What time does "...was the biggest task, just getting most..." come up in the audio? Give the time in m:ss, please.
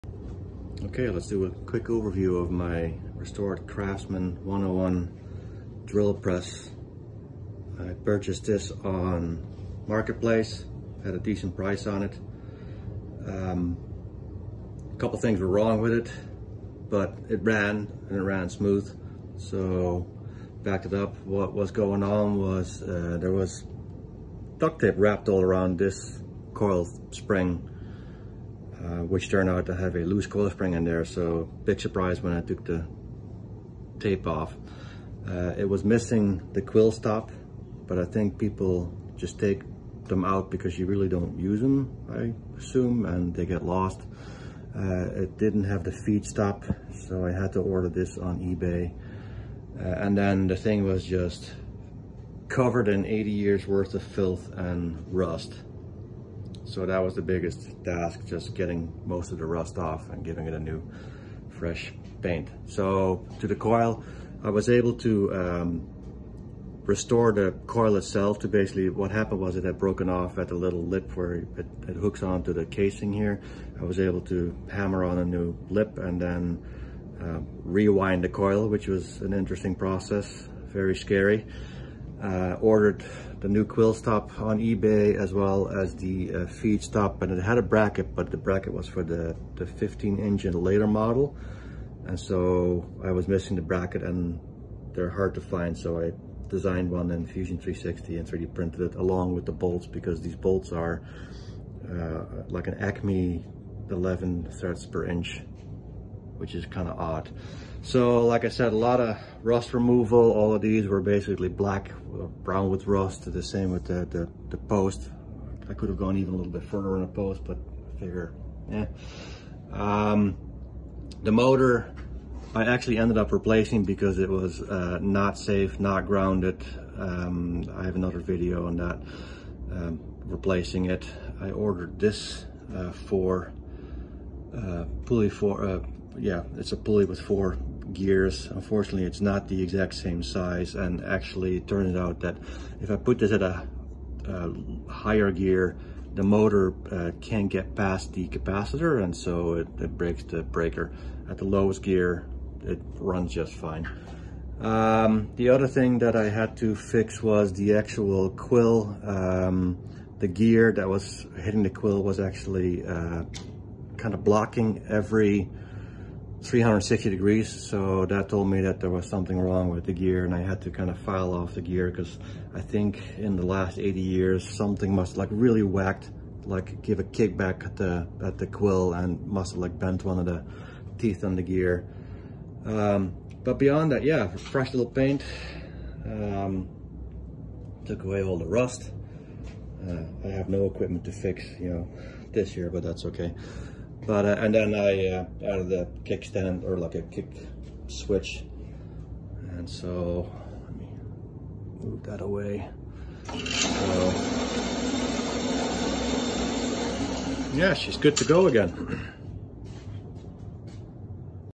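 0:57.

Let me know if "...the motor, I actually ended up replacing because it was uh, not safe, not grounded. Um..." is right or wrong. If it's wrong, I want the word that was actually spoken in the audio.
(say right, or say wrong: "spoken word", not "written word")
right.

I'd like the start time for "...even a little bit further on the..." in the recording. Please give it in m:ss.
1:56.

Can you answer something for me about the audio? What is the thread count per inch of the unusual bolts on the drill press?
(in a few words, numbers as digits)
11.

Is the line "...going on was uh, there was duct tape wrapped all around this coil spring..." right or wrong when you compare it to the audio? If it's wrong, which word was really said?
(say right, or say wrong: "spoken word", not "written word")
right.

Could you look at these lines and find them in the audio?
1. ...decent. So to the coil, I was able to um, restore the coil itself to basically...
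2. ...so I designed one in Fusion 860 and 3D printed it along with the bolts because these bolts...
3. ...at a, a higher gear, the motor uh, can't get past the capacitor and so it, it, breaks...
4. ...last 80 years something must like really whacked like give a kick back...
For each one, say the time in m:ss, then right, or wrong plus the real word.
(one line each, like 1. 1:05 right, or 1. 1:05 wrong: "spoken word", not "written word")
1. 1:02 wrong: "paint", not "decent"
2. 1:35 wrong: "360", not "860"
3. 2:23 right
4. 2:53 right.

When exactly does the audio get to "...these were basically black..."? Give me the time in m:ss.
1:50.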